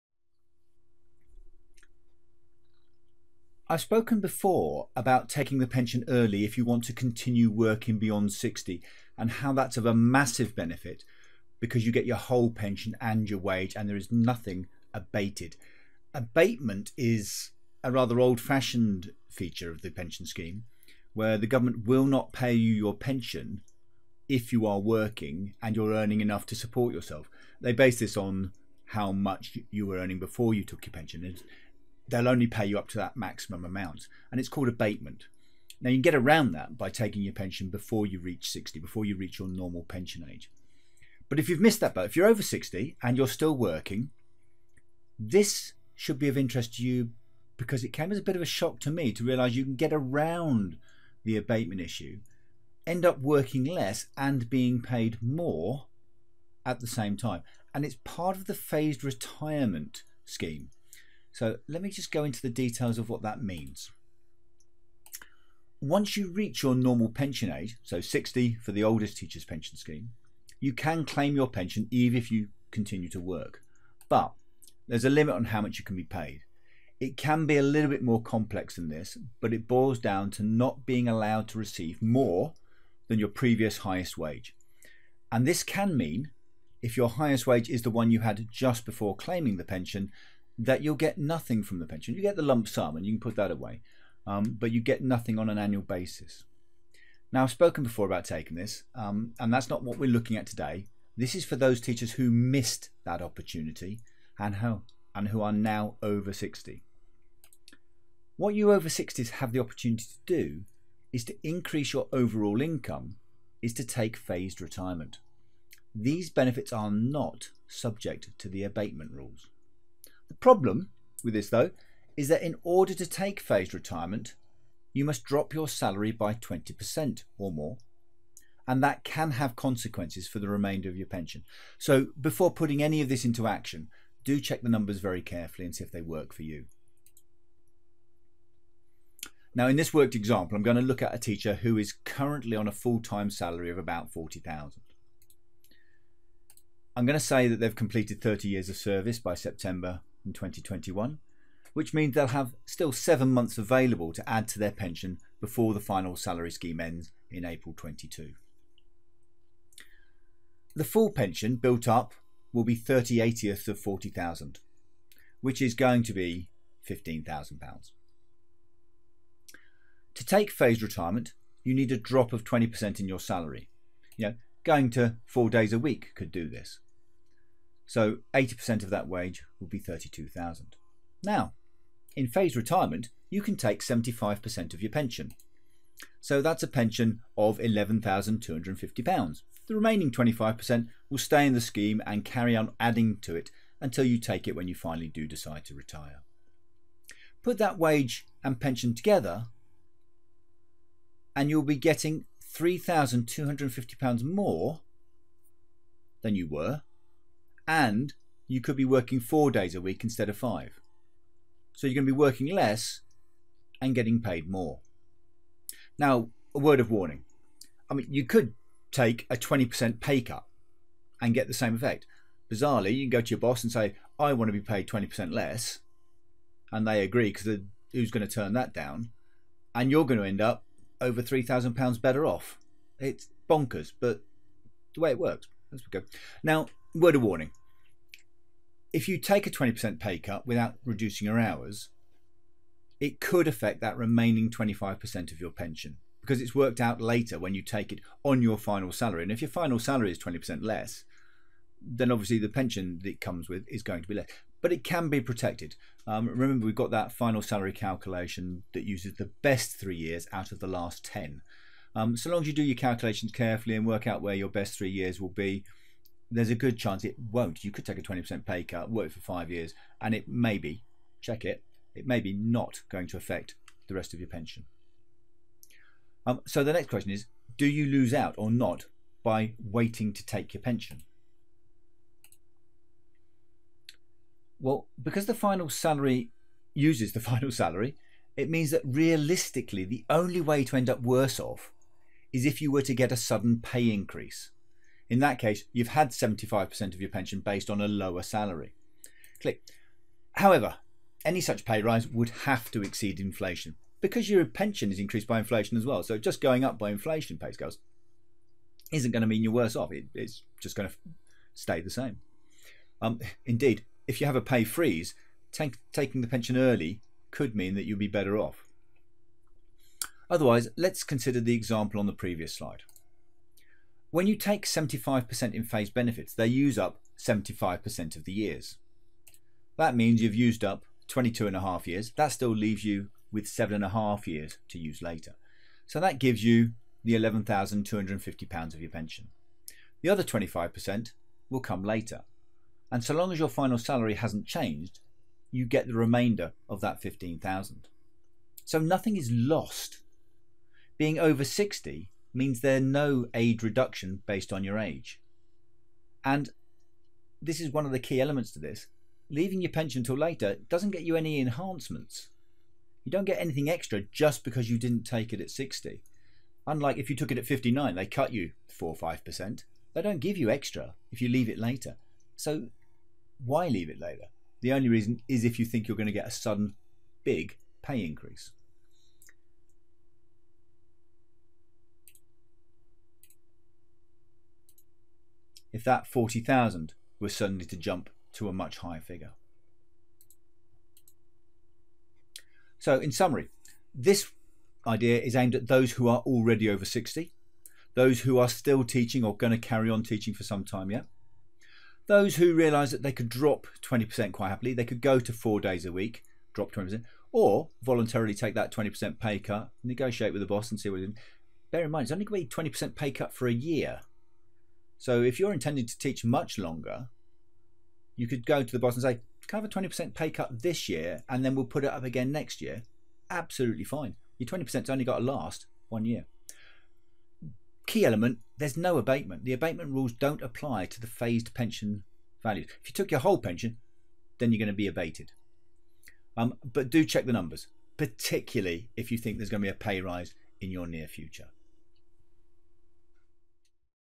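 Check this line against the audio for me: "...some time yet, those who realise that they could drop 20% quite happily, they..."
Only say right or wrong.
right.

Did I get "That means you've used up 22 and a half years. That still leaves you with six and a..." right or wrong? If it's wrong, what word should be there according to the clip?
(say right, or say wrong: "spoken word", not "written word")
wrong: "seven", not "six".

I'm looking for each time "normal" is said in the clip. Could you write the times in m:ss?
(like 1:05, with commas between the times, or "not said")
0:39, 1:06.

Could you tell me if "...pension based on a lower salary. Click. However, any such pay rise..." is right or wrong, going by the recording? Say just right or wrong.
right.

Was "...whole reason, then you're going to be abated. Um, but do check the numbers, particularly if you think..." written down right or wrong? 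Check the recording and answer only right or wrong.
wrong.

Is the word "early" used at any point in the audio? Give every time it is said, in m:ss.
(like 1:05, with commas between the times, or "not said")
0:06, 5:16.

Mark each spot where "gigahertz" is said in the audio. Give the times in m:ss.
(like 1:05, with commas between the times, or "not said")
not said.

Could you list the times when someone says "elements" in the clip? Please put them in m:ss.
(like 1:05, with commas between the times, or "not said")
5:58, 7:08.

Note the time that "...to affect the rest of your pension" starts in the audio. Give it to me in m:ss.
4:33.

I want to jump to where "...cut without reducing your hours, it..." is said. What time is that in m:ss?
4:00.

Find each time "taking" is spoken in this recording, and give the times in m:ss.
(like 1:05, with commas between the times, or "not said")
0:05, 0:36, 1:38, 5:15.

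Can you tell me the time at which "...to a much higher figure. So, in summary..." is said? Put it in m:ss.
6:28.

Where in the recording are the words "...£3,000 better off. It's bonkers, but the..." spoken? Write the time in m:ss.
3:51.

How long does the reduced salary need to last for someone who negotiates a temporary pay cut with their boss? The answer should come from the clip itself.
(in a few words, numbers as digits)
One year.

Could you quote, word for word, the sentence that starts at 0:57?
And it's part of the phased retirement scheme.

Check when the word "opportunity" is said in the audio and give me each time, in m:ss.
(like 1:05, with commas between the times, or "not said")
1:43, 1:49.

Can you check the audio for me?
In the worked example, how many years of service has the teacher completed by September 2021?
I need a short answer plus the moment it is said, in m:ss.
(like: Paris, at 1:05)
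30 years, at 2:28.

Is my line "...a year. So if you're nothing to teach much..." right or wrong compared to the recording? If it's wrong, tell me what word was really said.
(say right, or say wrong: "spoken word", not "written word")
wrong: "intending", not "nothing".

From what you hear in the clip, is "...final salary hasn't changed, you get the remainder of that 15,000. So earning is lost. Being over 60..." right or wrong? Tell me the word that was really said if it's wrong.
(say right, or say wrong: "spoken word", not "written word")
wrong: "nothing", not "earning".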